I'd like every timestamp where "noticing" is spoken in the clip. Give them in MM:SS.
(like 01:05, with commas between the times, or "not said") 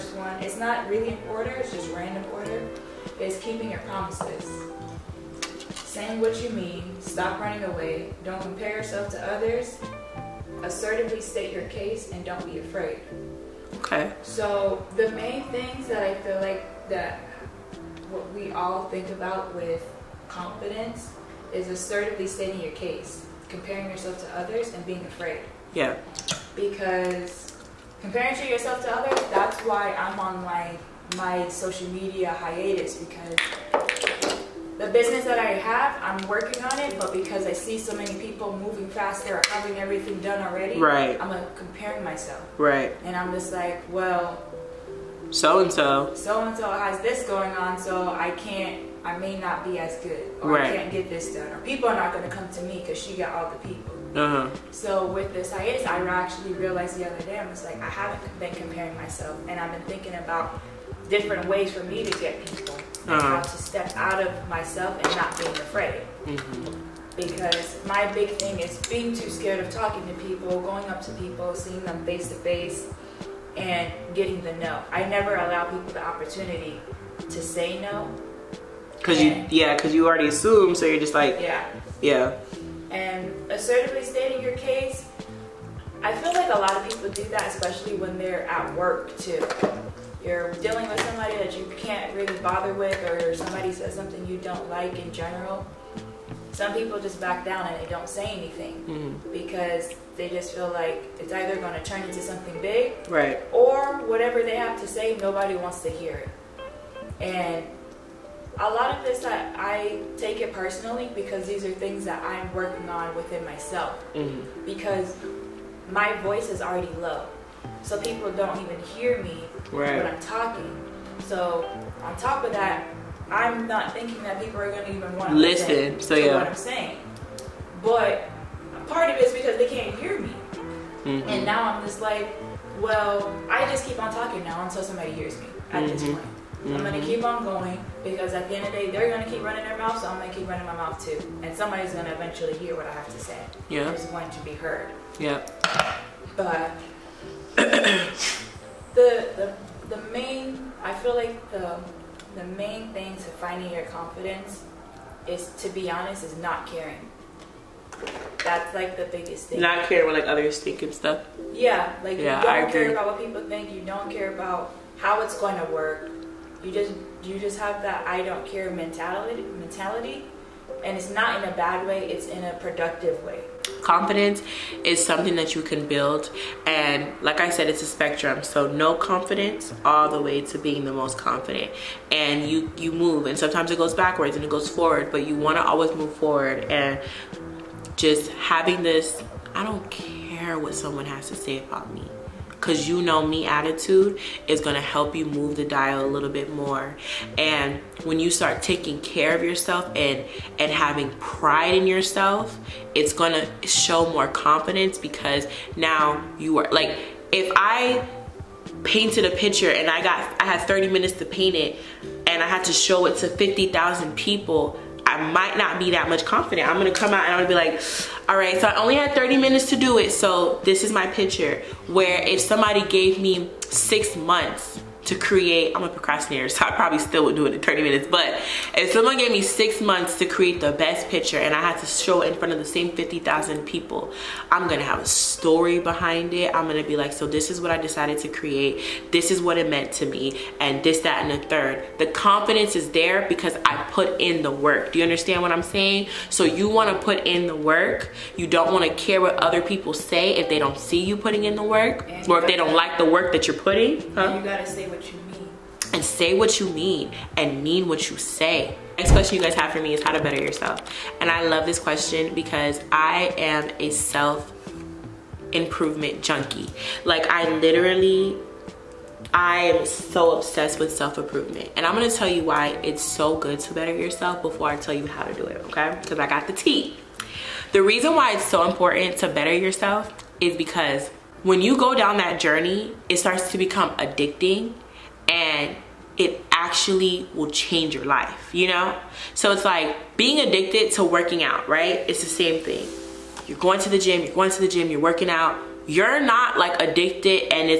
not said.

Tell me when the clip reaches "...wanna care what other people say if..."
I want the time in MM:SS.
04:08.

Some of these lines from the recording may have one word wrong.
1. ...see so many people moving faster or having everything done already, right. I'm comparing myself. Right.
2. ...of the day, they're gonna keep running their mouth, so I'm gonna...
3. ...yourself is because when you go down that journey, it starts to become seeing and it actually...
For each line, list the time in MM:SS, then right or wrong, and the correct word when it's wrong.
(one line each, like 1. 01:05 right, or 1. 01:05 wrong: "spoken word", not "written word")
1. 00:37 right
2. 02:18 right
3. 04:39 wrong: "addicting", not "seeing".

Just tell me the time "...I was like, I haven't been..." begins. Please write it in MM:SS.
00:57.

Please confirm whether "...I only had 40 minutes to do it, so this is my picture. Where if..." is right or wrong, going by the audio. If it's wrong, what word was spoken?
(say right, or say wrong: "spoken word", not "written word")
wrong: "30", not "40".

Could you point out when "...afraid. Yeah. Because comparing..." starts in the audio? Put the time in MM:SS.
00:25.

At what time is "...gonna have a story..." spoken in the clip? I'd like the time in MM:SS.
03:54.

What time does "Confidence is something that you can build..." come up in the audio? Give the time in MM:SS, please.
02:53.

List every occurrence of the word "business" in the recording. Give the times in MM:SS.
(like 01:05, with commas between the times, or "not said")
00:34.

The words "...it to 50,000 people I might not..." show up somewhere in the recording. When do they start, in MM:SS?
03:33.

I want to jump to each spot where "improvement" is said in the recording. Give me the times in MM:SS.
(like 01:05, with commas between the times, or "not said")
04:25, 04:30.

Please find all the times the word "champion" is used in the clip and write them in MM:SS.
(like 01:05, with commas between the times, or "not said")
not said.